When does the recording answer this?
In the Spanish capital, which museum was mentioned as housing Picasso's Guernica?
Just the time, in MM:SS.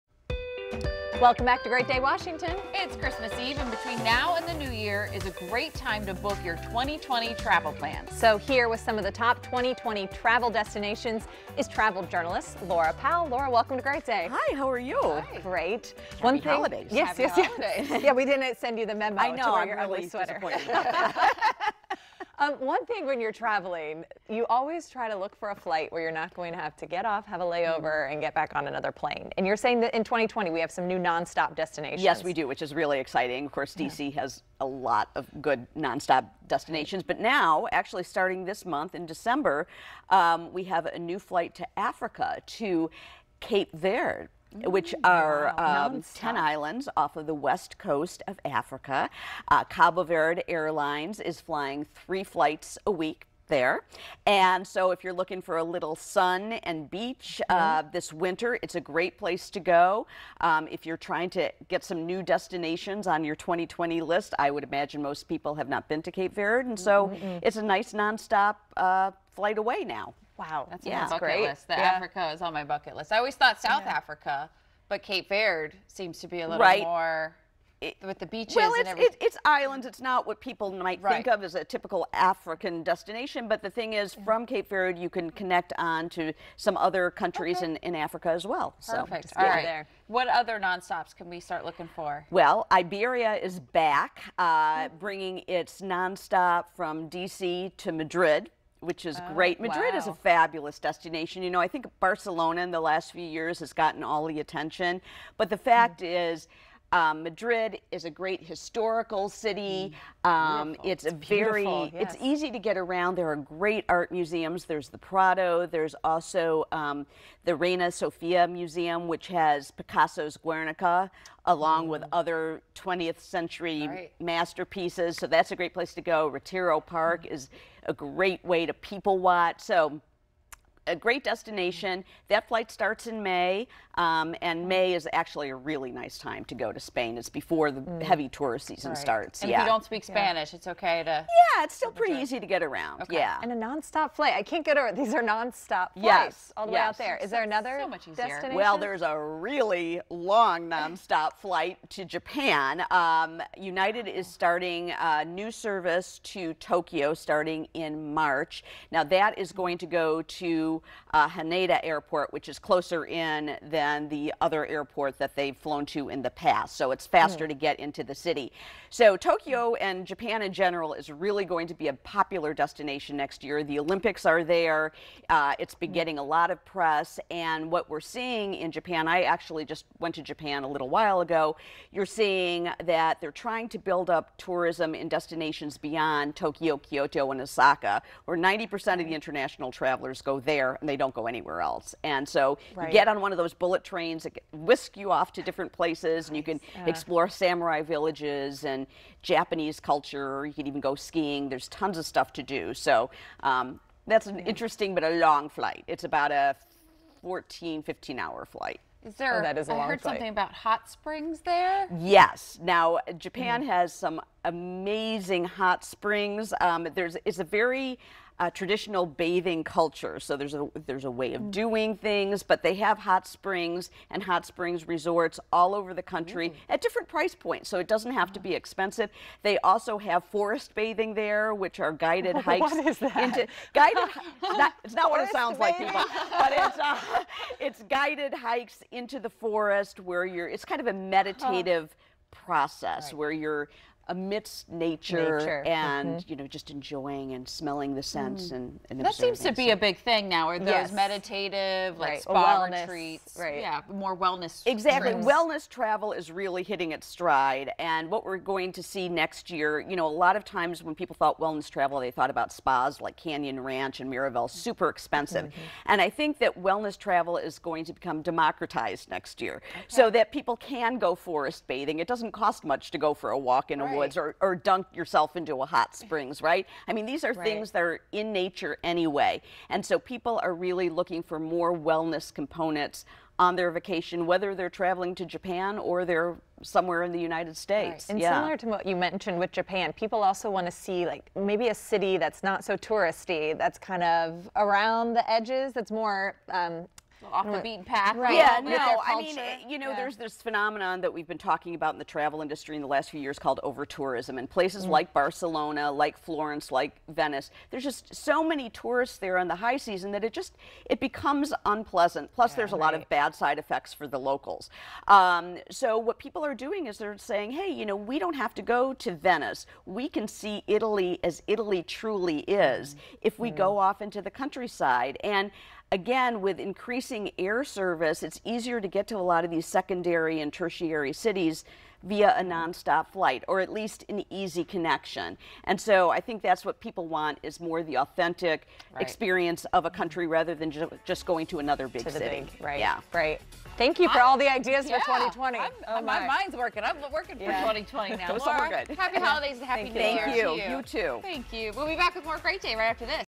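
01:57.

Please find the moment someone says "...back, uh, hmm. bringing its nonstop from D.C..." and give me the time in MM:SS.
01:33.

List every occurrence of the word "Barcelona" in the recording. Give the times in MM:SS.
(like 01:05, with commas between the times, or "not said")
01:41, 05:05.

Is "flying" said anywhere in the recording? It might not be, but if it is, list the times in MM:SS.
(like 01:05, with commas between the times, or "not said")
00:51.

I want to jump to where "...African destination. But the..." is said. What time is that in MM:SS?
01:22.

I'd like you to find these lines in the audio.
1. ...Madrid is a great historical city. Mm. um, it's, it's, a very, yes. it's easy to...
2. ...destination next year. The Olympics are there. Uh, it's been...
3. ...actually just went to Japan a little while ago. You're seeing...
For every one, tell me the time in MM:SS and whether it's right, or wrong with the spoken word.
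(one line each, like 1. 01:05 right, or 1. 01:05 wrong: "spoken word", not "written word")
1. 01:47 right
2. 02:52 right
3. 02:59 right.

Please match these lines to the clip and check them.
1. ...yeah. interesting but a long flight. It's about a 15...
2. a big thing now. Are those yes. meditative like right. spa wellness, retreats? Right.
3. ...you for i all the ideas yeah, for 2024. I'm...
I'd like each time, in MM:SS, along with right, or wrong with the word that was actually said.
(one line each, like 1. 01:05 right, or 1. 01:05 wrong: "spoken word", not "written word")
1. 03:24 wrong: "14", not "15"
2. 04:09 right
3. 05:43 wrong: "2020", not "2024".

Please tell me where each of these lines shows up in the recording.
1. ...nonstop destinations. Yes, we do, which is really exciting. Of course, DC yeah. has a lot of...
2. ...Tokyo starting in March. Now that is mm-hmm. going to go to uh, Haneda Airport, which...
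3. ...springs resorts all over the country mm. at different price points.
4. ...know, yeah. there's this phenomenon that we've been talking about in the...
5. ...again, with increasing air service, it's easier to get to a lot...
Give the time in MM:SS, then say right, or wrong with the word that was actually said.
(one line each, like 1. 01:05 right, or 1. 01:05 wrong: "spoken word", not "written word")
1. 00:30 right
2. 02:36 right
3. 03:44 right
4. 04:59 right
5. 05:25 right.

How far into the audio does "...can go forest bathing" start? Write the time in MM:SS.
04:30.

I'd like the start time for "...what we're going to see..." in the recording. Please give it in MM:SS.
04:18.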